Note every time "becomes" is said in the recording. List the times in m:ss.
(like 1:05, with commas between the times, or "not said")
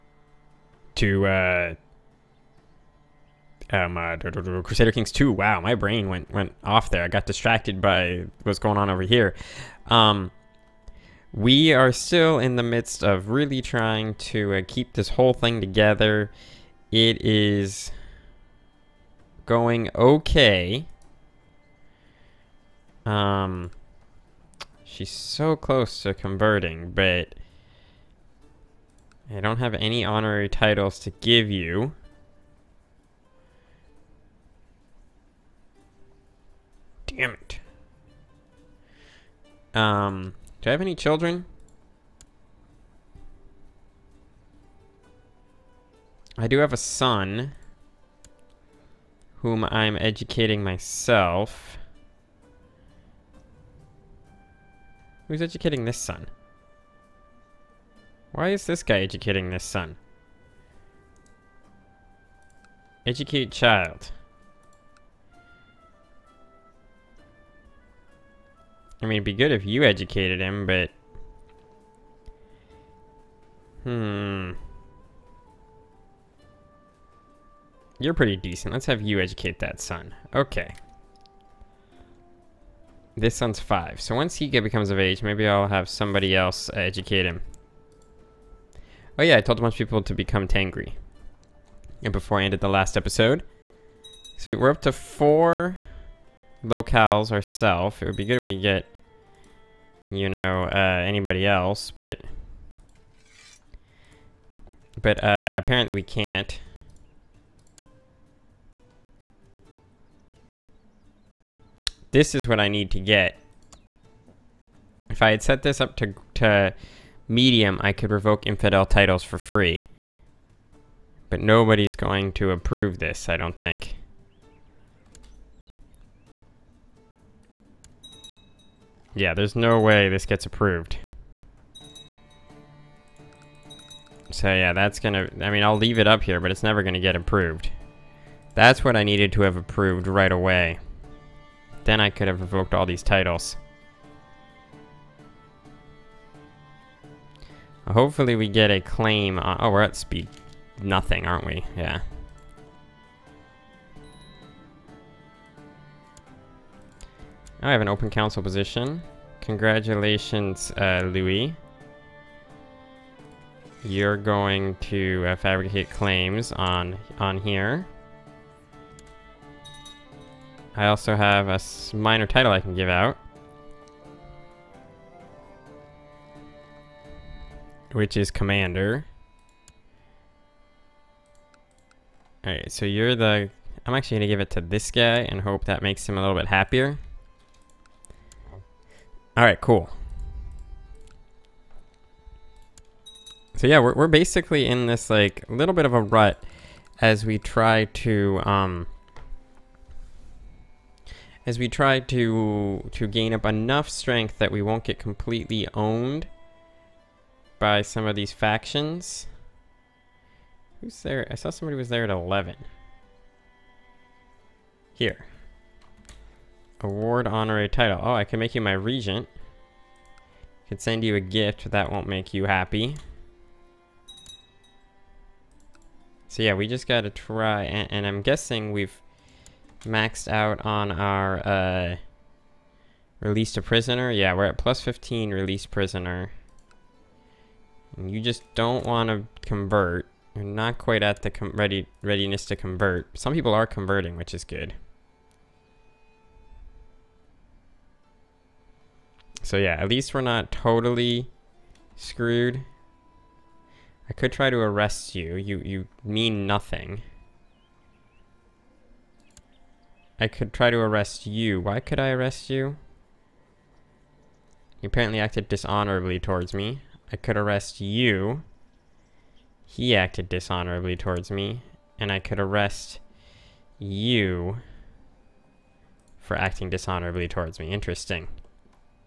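1:24, 1:30.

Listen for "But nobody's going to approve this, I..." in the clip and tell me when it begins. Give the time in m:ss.
2:01.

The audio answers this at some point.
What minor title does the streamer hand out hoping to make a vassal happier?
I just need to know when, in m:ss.
2:58.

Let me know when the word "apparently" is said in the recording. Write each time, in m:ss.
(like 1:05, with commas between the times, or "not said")
1:45, 4:24.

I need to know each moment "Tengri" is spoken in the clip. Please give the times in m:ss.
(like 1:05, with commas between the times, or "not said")
1:30.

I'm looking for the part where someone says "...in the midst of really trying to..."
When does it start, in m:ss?
0:12.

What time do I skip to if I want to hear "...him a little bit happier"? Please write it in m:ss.
3:06.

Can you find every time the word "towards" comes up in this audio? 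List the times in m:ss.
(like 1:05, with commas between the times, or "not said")
4:26, 4:30, 4:37.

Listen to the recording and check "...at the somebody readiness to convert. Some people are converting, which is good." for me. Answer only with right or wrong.
wrong.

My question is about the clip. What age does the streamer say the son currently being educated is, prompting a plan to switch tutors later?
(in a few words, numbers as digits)
5.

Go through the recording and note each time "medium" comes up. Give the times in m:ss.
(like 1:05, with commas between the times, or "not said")
1:57.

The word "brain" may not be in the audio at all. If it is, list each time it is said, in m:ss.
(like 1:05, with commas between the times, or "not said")
0:05.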